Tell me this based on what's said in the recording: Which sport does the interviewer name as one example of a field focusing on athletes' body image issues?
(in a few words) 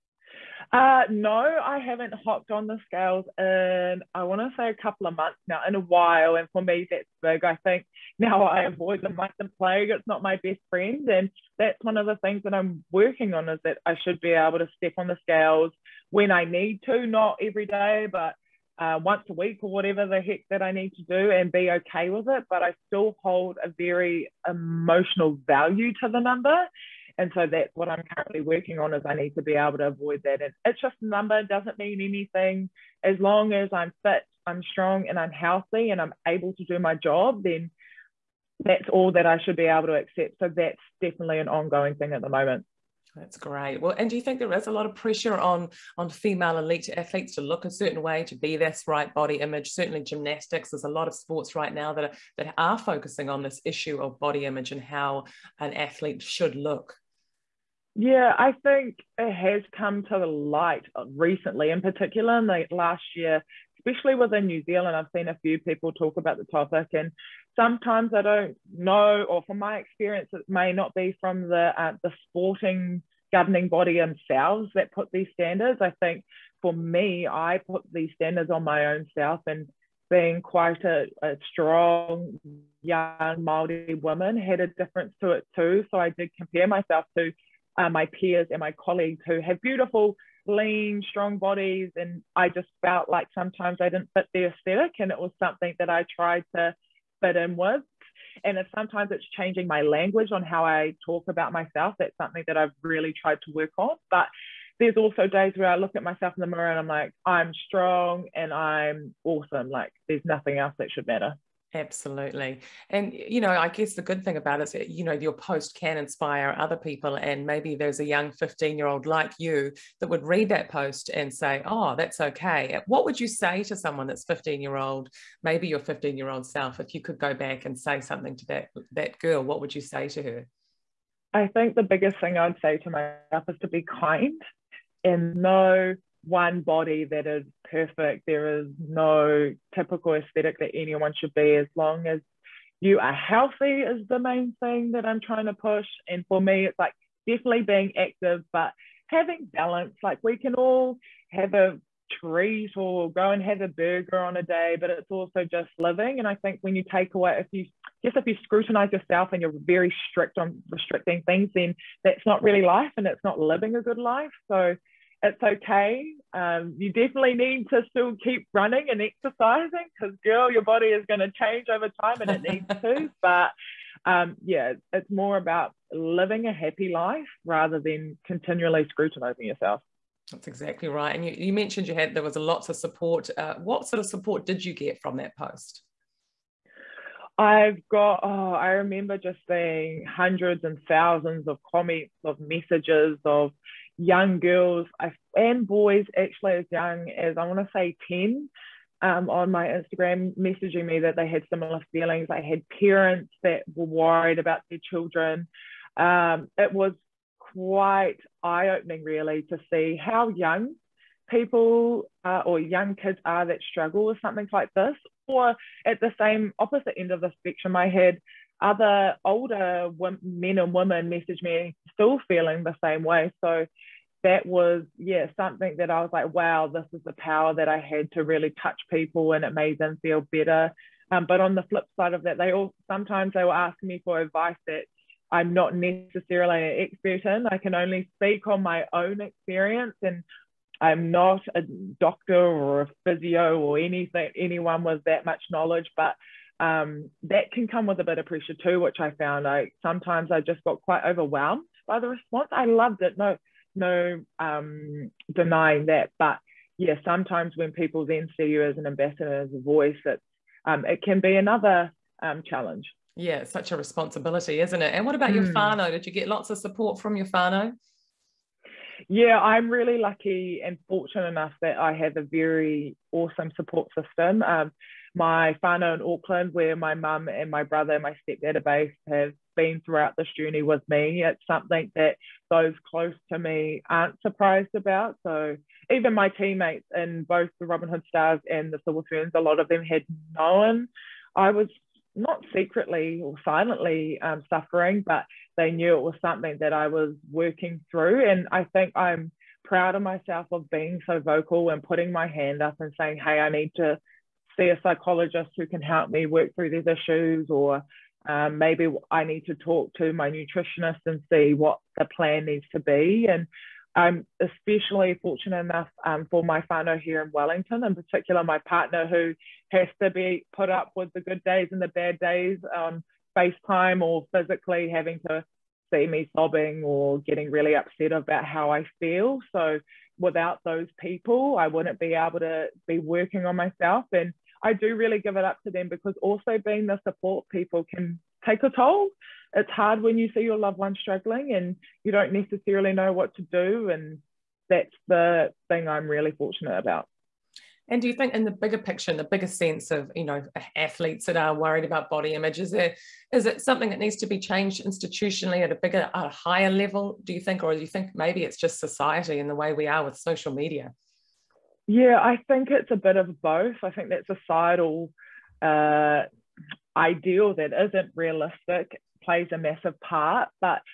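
gymnastics.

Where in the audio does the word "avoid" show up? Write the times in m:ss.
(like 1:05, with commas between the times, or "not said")
0:08, 0:29.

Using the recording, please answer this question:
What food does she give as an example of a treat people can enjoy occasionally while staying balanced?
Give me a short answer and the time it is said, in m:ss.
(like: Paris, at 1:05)
burger, at 2:33.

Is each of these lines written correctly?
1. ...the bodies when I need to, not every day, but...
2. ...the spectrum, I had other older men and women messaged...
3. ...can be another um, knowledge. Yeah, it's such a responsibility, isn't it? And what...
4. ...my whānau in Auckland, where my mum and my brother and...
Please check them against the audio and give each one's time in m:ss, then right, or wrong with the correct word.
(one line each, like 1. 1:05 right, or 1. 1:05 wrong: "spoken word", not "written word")
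1. 0:15 wrong: "scales", not "bodies"
2. 3:37 right
3. 4:21 wrong: "challenge", not "knowledge"
4. 4:35 right.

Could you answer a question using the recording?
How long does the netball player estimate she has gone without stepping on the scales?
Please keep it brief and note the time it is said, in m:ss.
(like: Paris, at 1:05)
a couple of months, at 0:04.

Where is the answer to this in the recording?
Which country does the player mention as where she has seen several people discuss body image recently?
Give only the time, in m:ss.
1:04.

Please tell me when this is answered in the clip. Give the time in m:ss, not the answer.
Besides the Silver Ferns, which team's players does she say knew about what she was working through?
4:47.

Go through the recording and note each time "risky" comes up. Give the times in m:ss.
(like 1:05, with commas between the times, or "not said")
not said.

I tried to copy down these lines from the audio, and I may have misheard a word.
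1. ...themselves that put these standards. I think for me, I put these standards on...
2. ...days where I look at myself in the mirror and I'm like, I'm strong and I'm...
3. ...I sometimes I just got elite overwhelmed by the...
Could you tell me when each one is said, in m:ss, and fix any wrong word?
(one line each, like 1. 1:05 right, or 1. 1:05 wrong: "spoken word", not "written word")
1. 1:13 right
2. 1:45 right
3. 4:09 wrong: "quite", not "elite".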